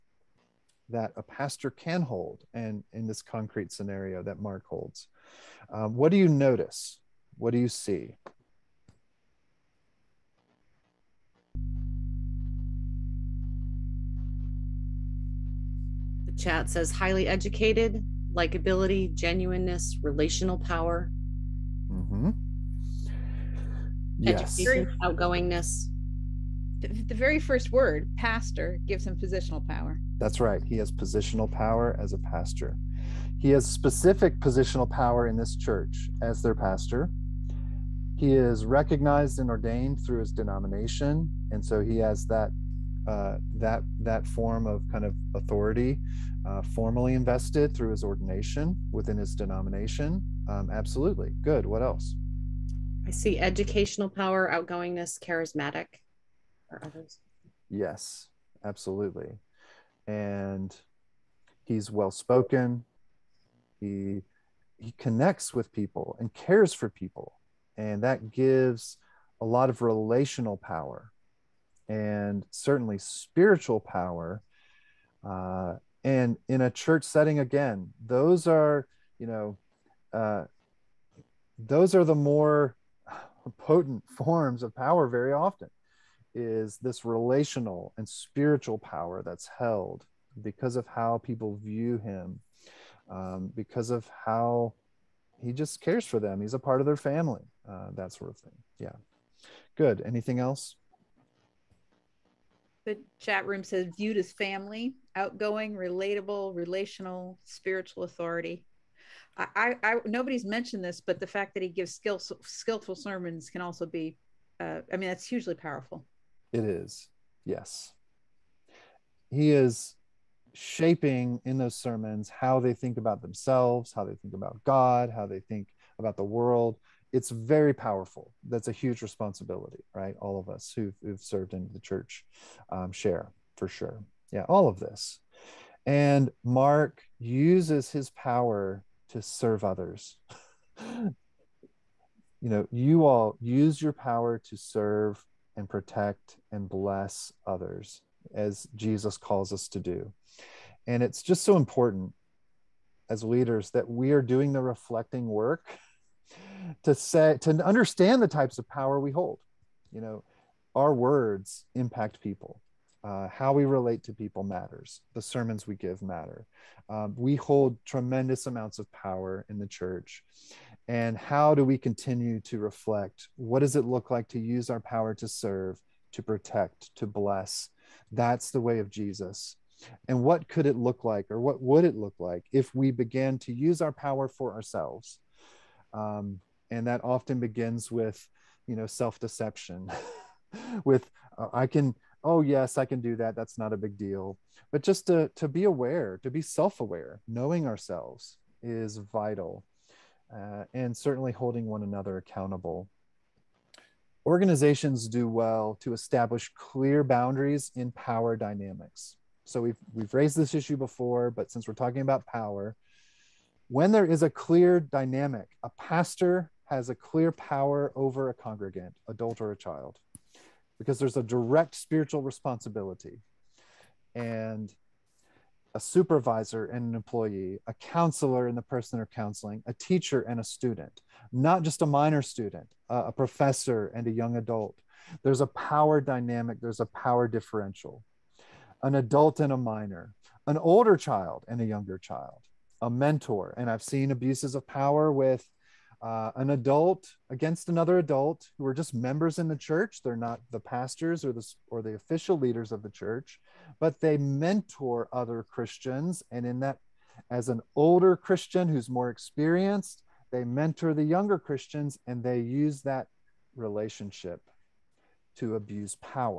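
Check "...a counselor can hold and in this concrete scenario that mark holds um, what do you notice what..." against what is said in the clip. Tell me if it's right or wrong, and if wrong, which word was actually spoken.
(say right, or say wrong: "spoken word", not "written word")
wrong: "pastor", not "counselor".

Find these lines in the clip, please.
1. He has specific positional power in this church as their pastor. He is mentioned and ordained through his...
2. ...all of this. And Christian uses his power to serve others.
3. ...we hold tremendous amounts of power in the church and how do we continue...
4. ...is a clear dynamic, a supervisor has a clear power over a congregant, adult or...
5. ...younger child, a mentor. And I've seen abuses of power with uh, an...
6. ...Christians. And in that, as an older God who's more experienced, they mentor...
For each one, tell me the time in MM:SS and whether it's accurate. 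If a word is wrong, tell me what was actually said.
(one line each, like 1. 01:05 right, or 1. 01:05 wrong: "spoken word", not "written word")
1. 00:33 wrong: "recognized", not "mentioned"
2. 02:14 wrong: "Mark", not "Christian"
3. 02:47 right
4. 03:34 wrong: "pastor", not "supervisor"
5. 04:01 right
6. 04:15 wrong: "Christian", not "God".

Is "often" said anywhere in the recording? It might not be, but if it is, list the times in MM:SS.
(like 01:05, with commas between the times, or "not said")
01:25, 03:07.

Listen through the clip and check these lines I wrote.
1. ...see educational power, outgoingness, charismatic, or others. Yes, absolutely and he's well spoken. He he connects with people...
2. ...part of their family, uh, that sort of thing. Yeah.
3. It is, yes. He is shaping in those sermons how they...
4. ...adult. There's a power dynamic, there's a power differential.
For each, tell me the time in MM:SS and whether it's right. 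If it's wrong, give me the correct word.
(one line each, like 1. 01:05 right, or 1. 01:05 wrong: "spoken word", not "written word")
1. 00:53 right
2. 01:36 right
3. 01:56 right
4. 03:54 right.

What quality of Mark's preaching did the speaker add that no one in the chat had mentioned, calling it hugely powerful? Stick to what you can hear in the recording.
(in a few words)
Skillful sermons.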